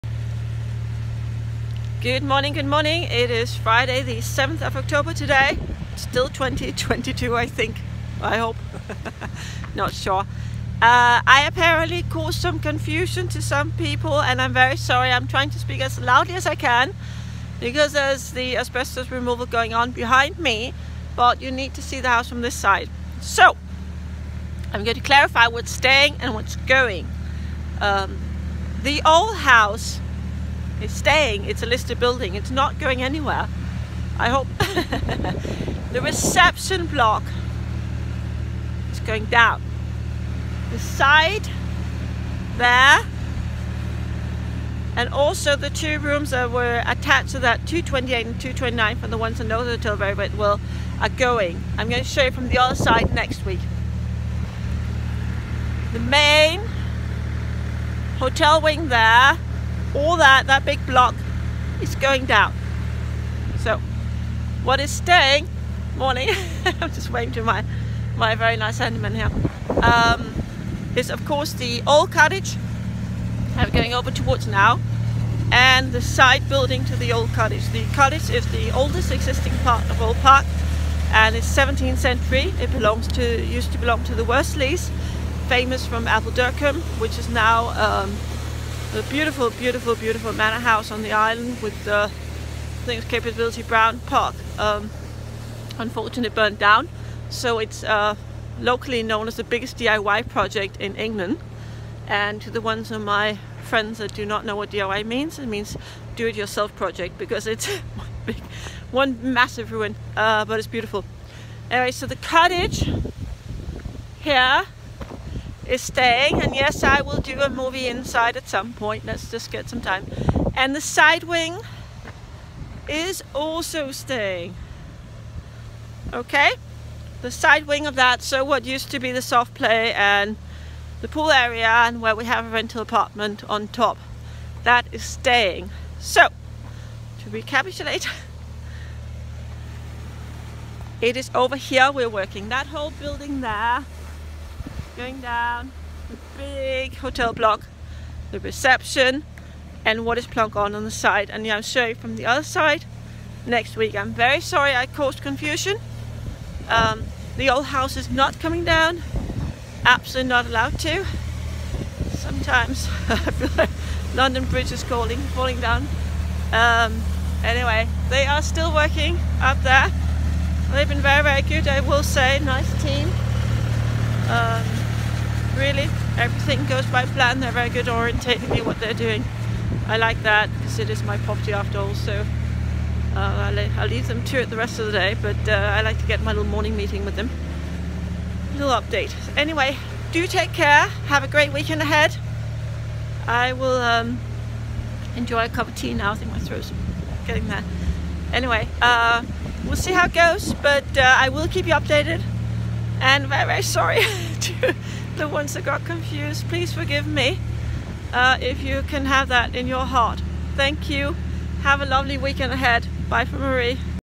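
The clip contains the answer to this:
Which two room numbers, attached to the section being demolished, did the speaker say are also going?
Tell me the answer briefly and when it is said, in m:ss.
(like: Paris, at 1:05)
228 and 229, at 0:47.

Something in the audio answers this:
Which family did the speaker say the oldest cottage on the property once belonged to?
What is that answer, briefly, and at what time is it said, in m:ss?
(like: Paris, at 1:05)
The Worsleys, at 1:24.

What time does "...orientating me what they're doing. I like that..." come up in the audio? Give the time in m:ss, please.
2:57.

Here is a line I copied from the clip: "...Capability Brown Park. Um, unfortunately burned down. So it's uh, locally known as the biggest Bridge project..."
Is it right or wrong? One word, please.
wrong.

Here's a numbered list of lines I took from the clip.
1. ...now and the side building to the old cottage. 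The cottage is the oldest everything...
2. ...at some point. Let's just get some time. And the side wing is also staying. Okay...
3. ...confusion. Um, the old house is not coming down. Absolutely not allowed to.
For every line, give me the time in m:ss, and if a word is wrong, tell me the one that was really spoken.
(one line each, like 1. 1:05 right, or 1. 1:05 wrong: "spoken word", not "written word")
1. 1:14 wrong: "existing", not "everything"
2. 1:58 right
3. 2:35 right.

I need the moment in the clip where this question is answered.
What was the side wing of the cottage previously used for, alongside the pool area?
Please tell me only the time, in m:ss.
2:09.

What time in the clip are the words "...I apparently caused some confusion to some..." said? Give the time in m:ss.
0:11.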